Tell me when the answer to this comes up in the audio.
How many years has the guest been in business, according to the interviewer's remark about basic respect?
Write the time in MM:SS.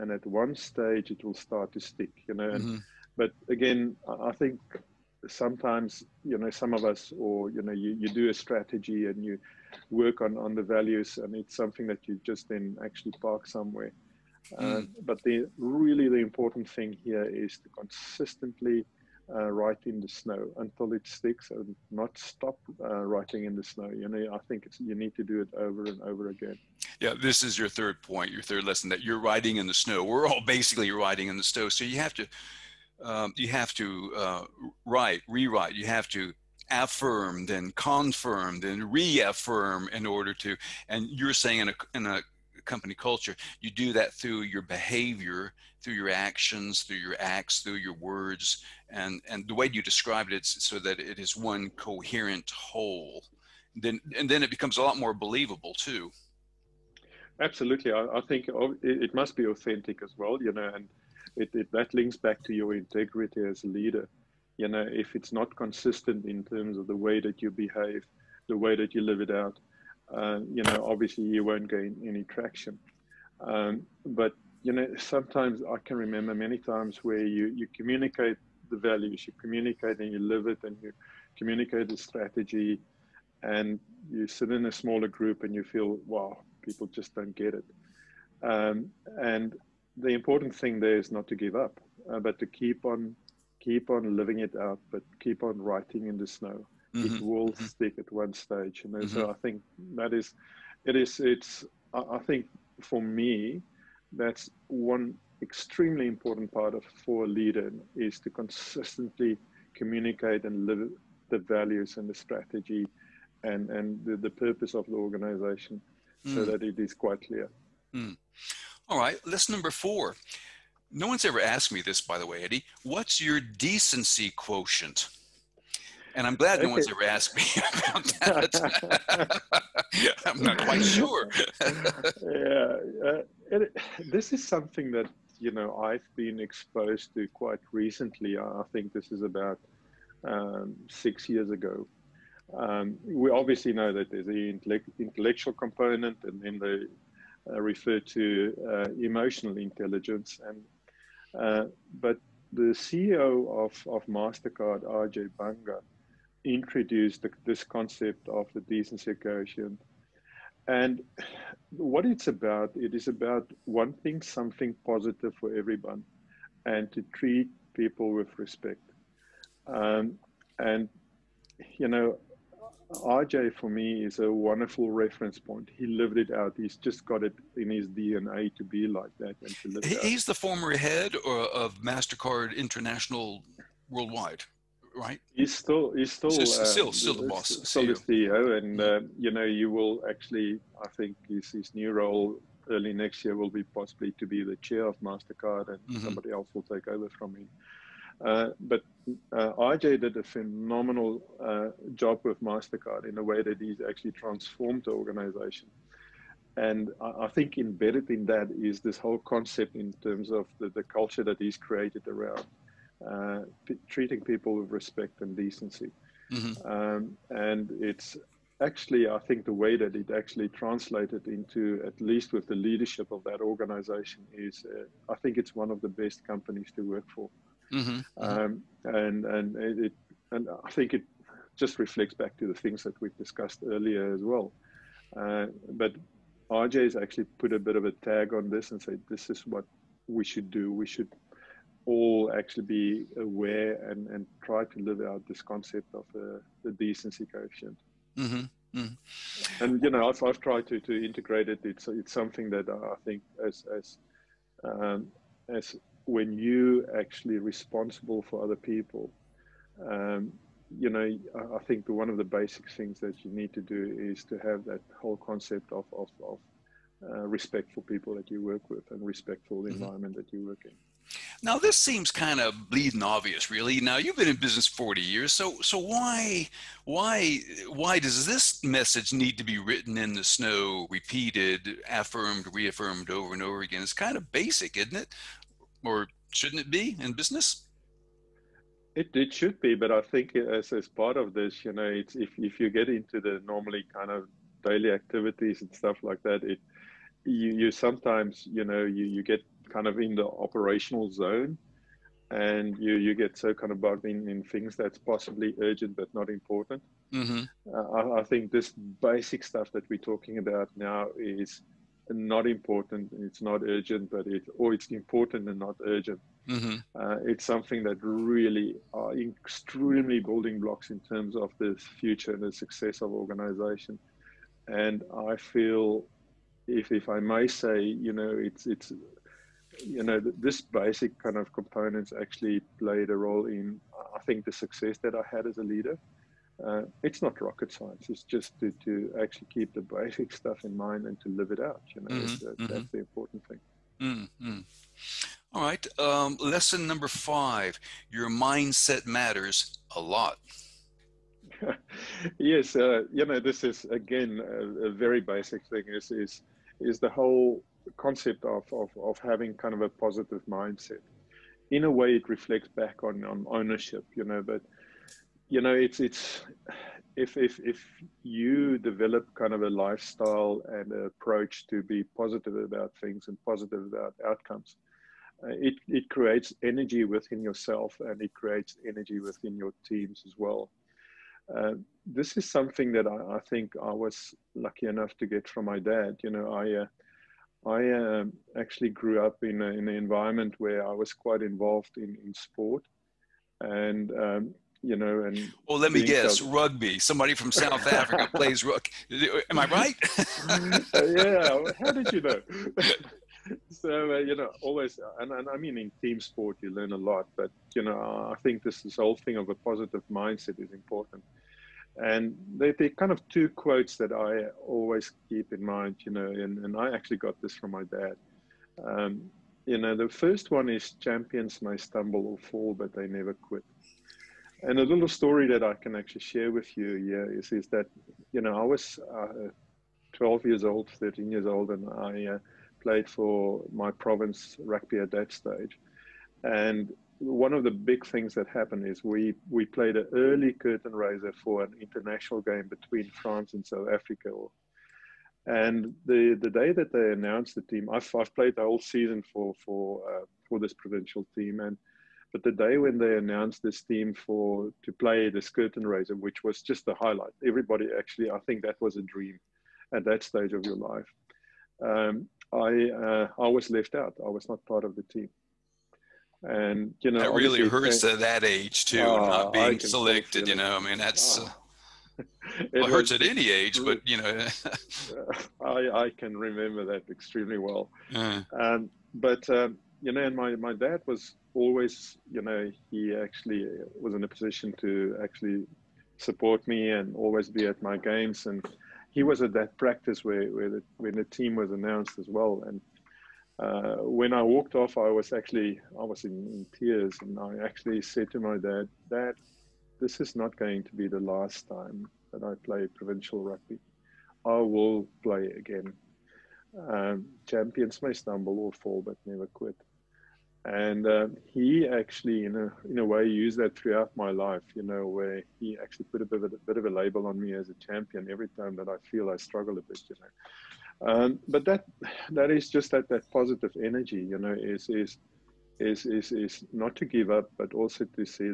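04:34.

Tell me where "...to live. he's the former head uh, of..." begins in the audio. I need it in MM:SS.
02:59.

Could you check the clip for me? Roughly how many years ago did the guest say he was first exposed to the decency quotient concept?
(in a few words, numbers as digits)
6.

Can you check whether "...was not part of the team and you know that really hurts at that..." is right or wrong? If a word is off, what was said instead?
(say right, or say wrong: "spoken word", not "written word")
right.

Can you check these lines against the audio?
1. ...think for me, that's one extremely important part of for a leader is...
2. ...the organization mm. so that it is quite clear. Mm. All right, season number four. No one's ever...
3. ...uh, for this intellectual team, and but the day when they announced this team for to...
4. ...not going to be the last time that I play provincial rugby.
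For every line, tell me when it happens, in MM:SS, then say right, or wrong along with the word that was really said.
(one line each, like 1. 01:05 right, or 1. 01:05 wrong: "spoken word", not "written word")
1. 01:42 right
2. 01:54 wrong: "lesson", not "season"
3. 07:30 wrong: "provincial", not "intellectual"
4. 08:20 right.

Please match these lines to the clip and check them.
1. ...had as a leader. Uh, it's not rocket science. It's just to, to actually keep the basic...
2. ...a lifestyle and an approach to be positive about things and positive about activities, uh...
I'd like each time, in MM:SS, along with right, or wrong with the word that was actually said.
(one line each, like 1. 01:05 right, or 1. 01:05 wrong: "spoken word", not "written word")
1. 05:35 right
2. 06:09 wrong: "outcomes", not "activities".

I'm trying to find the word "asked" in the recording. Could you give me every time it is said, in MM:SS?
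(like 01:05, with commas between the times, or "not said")
02:01, 02:07.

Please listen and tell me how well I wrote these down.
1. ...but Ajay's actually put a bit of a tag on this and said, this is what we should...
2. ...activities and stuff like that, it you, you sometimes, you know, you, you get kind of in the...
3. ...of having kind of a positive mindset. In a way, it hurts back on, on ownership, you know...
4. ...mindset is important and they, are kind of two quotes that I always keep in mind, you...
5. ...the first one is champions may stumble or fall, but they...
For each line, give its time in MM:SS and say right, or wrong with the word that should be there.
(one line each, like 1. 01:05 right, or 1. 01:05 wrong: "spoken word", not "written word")
1. 03:55 right
2. 04:54 right
3. 05:59 wrong: "reflects", not "hurts"
4. 06:50 right
5. 06:59 right.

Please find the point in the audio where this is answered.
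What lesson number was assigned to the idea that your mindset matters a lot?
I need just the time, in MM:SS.
05:47.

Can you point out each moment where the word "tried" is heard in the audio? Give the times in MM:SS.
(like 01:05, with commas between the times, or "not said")
04:10.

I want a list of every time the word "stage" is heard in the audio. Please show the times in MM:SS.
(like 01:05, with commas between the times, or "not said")
00:00, 01:38, 07:15, 07:40.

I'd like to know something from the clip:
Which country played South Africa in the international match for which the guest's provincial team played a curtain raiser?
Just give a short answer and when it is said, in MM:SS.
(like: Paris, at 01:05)
France, at 07:23.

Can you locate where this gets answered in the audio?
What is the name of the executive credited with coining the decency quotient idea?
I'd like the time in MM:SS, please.
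02:34.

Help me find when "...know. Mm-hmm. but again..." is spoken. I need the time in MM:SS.
00:02.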